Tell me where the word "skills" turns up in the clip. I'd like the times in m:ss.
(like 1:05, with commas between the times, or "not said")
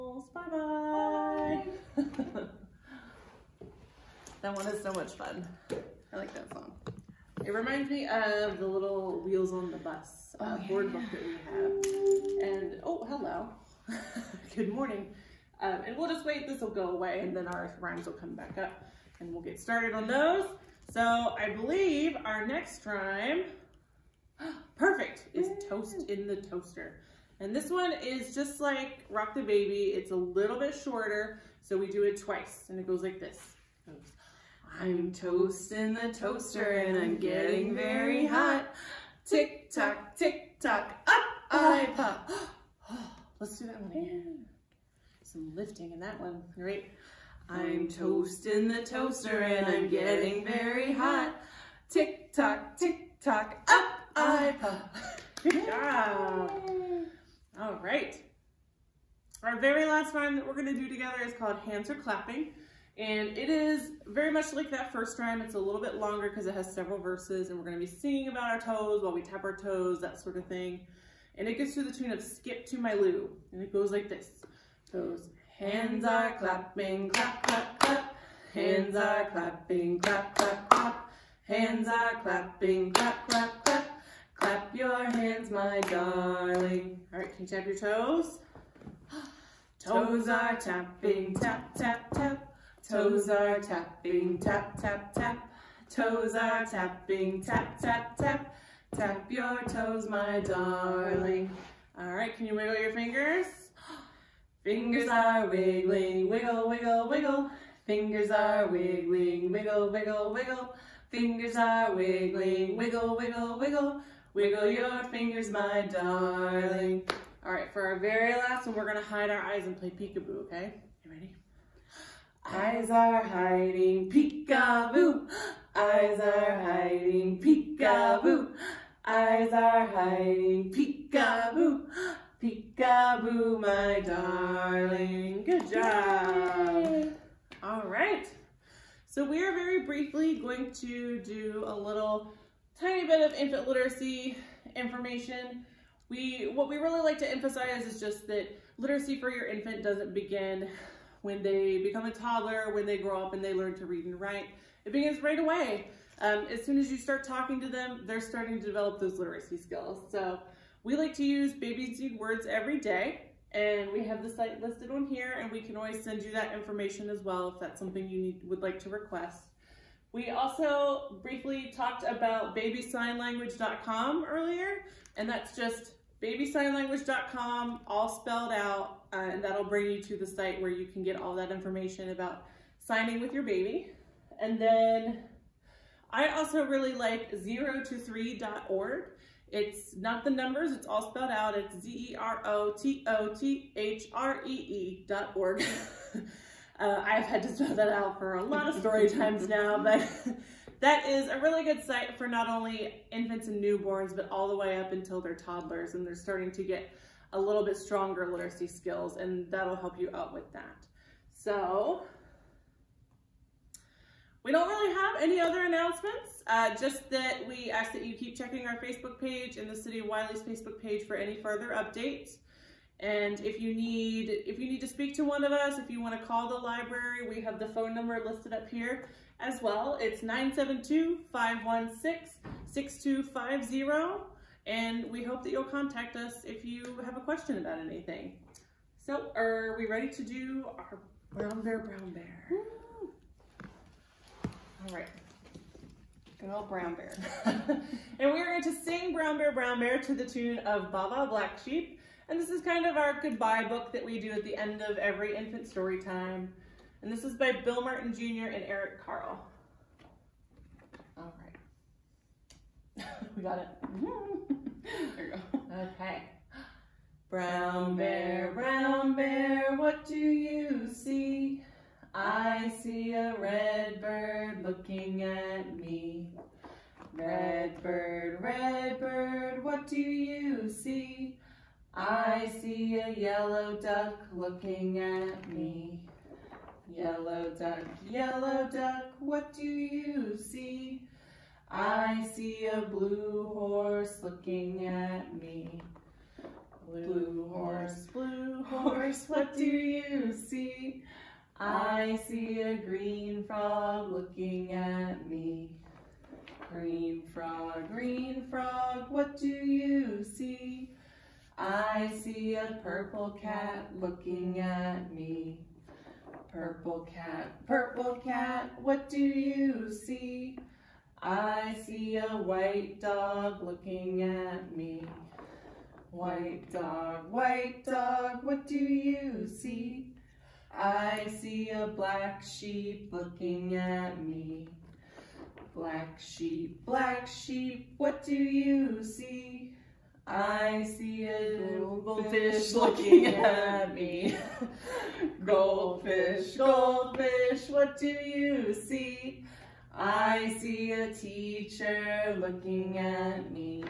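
2:39, 3:28.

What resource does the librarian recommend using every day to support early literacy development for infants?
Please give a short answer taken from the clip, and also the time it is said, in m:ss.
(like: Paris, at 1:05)
Babies Need Words, at 2:41.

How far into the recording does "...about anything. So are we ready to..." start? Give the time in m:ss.
3:57.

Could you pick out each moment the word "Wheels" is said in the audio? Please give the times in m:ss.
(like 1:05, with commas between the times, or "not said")
0:09.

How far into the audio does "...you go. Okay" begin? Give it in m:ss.
4:25.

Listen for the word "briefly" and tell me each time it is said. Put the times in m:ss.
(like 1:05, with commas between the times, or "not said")
2:19, 2:51.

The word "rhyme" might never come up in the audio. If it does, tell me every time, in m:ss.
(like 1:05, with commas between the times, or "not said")
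0:17, 0:22, 1:05.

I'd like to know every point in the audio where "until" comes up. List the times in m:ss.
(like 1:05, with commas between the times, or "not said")
3:24.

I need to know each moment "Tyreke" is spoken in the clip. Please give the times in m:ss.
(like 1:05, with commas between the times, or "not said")
not said.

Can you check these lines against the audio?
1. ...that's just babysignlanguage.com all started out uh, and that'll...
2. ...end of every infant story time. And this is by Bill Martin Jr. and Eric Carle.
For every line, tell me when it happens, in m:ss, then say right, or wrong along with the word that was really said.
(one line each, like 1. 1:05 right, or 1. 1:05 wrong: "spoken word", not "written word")
1. 2:55 wrong: "spelled", not "started"
2. 4:14 right.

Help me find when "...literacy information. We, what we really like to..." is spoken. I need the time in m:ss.
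2:23.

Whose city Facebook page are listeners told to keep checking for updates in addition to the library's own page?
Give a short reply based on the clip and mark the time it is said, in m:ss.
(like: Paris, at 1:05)
City of Wylie, at 3:39.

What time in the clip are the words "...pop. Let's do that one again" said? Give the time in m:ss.
0:41.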